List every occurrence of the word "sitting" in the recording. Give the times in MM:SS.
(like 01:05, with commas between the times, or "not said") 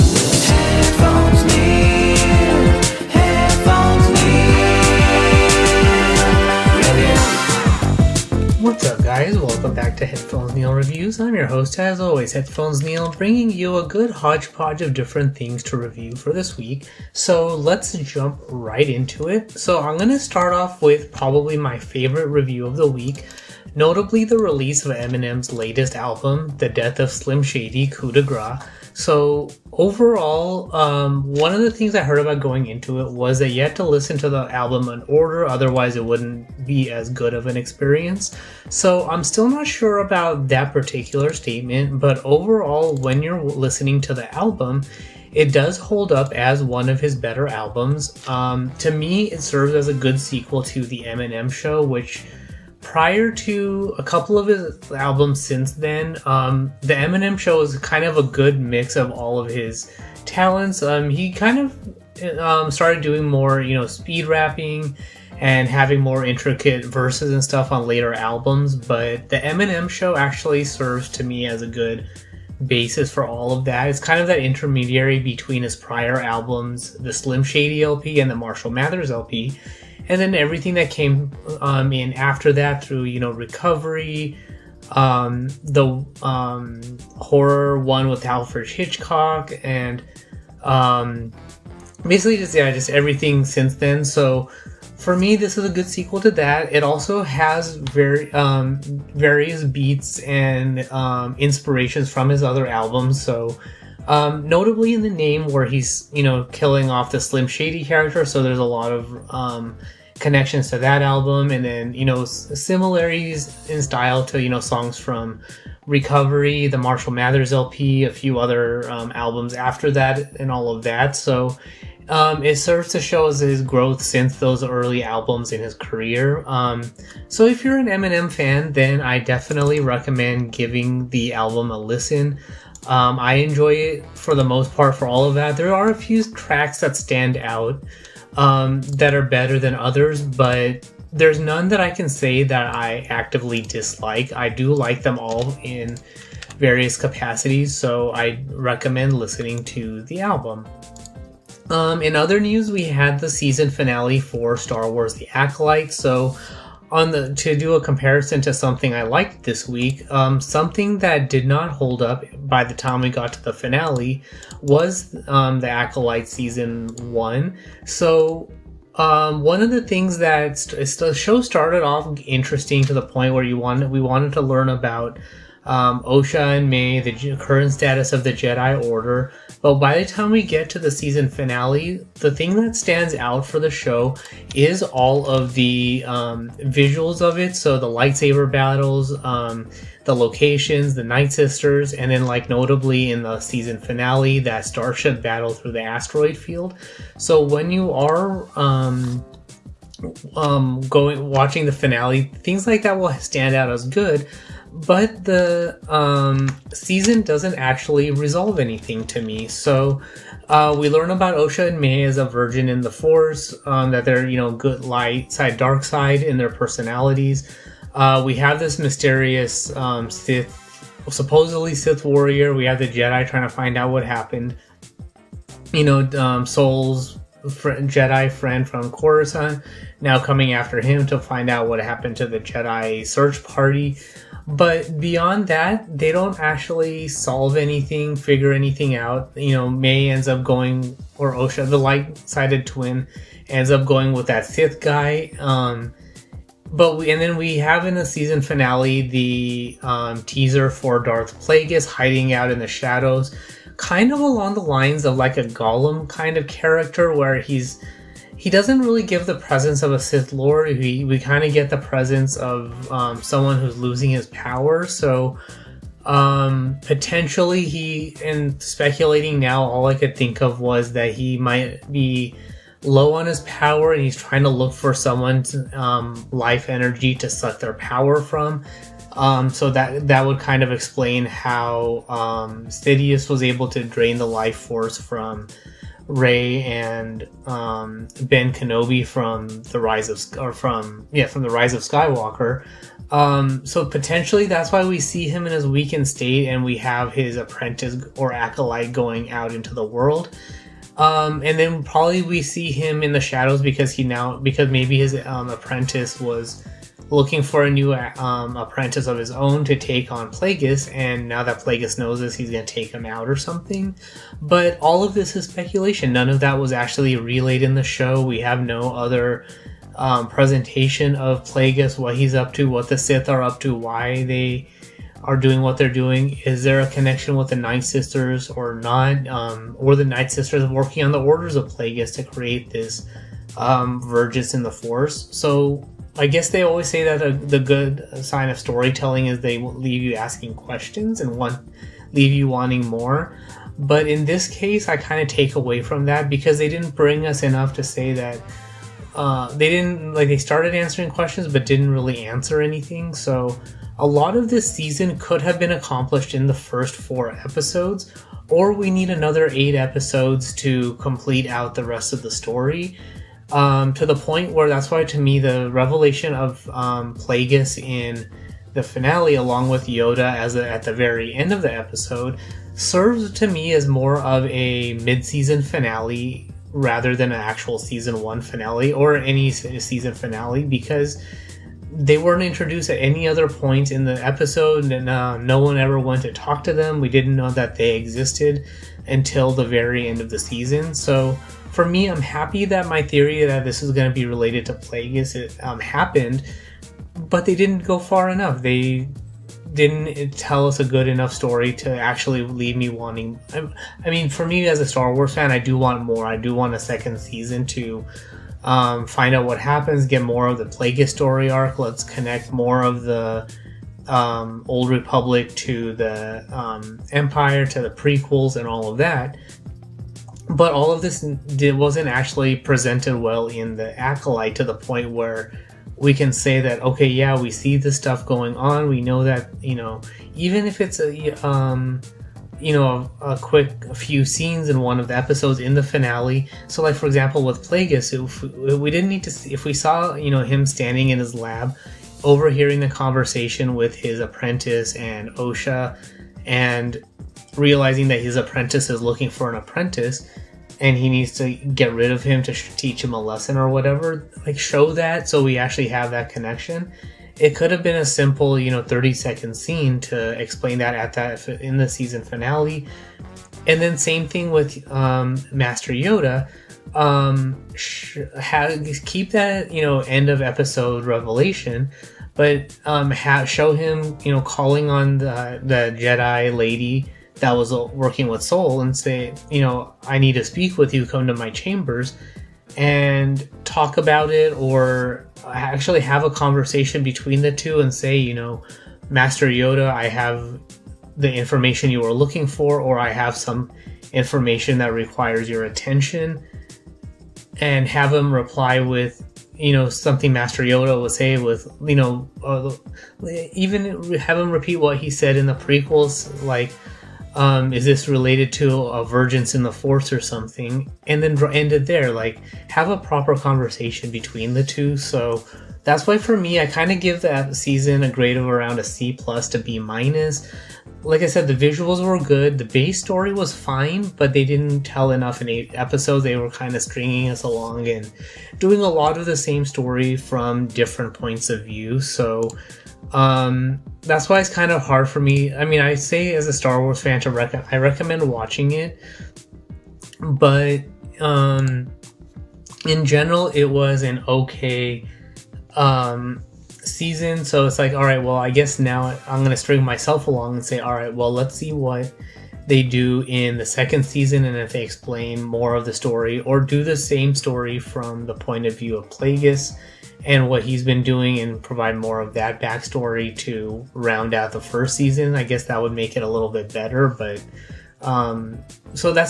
not said.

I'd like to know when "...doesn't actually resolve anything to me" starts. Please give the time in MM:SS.
03:27.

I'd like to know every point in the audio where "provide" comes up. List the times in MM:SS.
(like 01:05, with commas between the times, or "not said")
09:21.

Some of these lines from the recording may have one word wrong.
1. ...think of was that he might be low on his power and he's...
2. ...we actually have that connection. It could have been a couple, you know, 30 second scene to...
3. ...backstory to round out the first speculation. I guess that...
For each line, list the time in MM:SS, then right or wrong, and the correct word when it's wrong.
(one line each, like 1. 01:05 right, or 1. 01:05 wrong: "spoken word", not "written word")
1. 04:30 right
2. 07:35 wrong: "simple", not "couple"
3. 09:22 wrong: "season", not "speculation".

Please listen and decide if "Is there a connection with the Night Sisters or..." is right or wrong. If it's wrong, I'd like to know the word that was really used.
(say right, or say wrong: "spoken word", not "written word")
right.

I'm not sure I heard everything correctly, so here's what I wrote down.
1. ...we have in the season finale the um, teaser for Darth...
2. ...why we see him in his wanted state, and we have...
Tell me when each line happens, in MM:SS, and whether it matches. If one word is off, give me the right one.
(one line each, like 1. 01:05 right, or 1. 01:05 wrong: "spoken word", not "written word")
1. 04:07 right
2. 04:54 wrong: "weakened", not "wanted".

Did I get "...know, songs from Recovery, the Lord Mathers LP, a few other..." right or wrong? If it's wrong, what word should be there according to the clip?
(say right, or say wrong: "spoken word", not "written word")
wrong: "Marshall", not "Lord".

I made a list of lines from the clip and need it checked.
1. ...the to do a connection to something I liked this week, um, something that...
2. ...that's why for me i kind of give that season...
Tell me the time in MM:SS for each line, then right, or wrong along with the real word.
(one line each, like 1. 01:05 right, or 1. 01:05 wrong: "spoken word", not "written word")
1. 02:37 wrong: "comparison", not "connection"
2. 08:35 right.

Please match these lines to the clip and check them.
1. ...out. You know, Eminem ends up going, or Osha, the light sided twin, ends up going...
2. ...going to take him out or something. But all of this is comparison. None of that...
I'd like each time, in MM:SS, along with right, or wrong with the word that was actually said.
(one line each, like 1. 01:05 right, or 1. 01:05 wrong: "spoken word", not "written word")
1. 03:58 wrong: "Mae", not "Eminem"
2. 05:12 wrong: "speculation", not "comparison".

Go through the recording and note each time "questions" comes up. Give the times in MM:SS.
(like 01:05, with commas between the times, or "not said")
05:40, 05:51.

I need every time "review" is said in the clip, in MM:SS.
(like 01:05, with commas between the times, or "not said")
00:10, 00:15, 00:22.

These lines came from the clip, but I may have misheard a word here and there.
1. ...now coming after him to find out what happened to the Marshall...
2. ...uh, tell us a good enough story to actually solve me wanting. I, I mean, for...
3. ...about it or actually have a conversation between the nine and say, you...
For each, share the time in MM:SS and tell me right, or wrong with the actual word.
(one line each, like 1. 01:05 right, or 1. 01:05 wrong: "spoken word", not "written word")
1. 03:50 wrong: "Jedi", not "Marshall"
2. 06:40 wrong: "leave", not "solve"
3. 08:03 wrong: "two", not "nine".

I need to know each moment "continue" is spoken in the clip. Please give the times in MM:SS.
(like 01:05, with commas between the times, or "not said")
not said.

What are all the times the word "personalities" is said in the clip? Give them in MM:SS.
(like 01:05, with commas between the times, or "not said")
03:36.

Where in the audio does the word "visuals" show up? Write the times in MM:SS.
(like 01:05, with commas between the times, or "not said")
03:06, 08:41.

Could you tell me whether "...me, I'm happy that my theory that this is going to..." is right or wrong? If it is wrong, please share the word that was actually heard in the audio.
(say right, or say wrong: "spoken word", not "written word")
right.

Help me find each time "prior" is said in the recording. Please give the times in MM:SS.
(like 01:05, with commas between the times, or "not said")
00:52, 01:15.